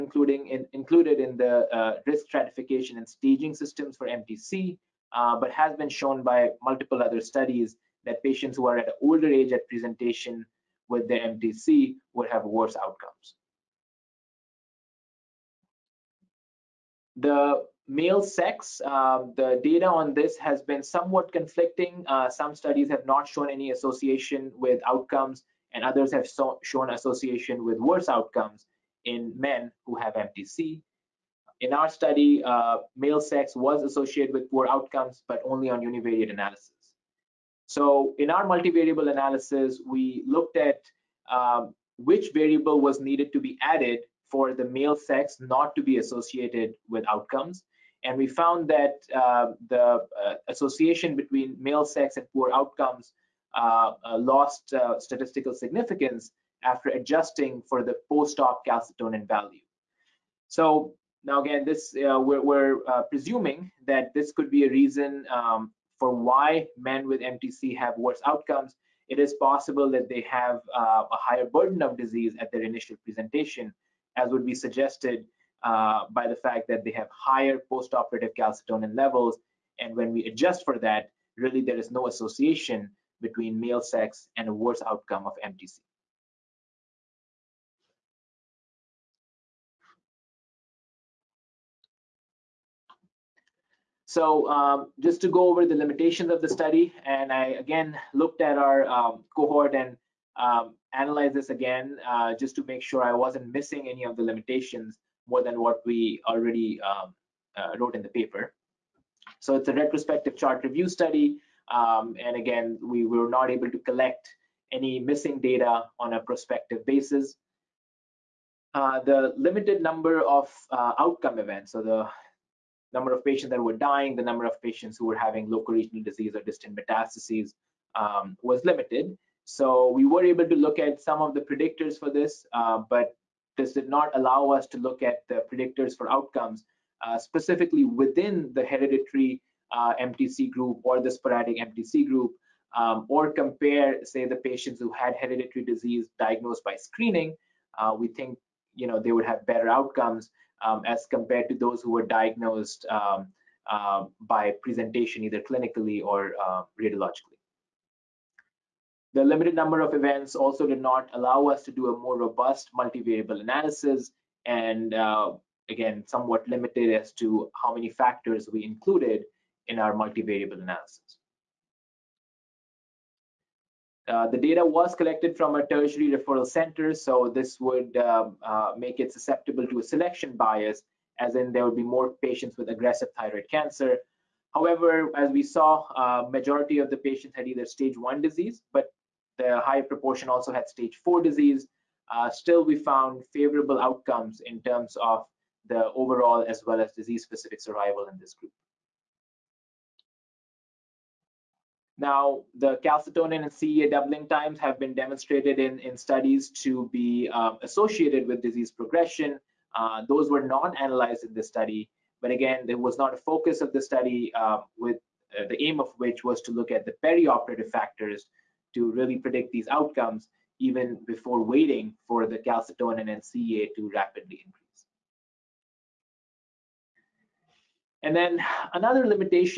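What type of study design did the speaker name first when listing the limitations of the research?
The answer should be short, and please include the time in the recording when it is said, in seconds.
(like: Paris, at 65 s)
retrospective chart review, at 109 s.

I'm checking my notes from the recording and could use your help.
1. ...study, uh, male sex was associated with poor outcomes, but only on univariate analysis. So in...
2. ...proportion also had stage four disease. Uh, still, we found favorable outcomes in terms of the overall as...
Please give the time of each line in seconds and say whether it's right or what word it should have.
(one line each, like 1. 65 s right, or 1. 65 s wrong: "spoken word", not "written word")
1. 31 s right
2. 189 s right.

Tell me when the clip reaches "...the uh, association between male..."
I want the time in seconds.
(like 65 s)
49 s.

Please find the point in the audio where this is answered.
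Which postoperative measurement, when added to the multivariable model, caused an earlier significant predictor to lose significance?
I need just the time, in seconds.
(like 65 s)
58 s.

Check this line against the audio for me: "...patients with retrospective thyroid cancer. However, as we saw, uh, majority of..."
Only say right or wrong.
wrong.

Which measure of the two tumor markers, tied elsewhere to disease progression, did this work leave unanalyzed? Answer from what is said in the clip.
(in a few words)
doubling times.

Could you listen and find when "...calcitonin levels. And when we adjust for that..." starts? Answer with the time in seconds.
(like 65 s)
78 s.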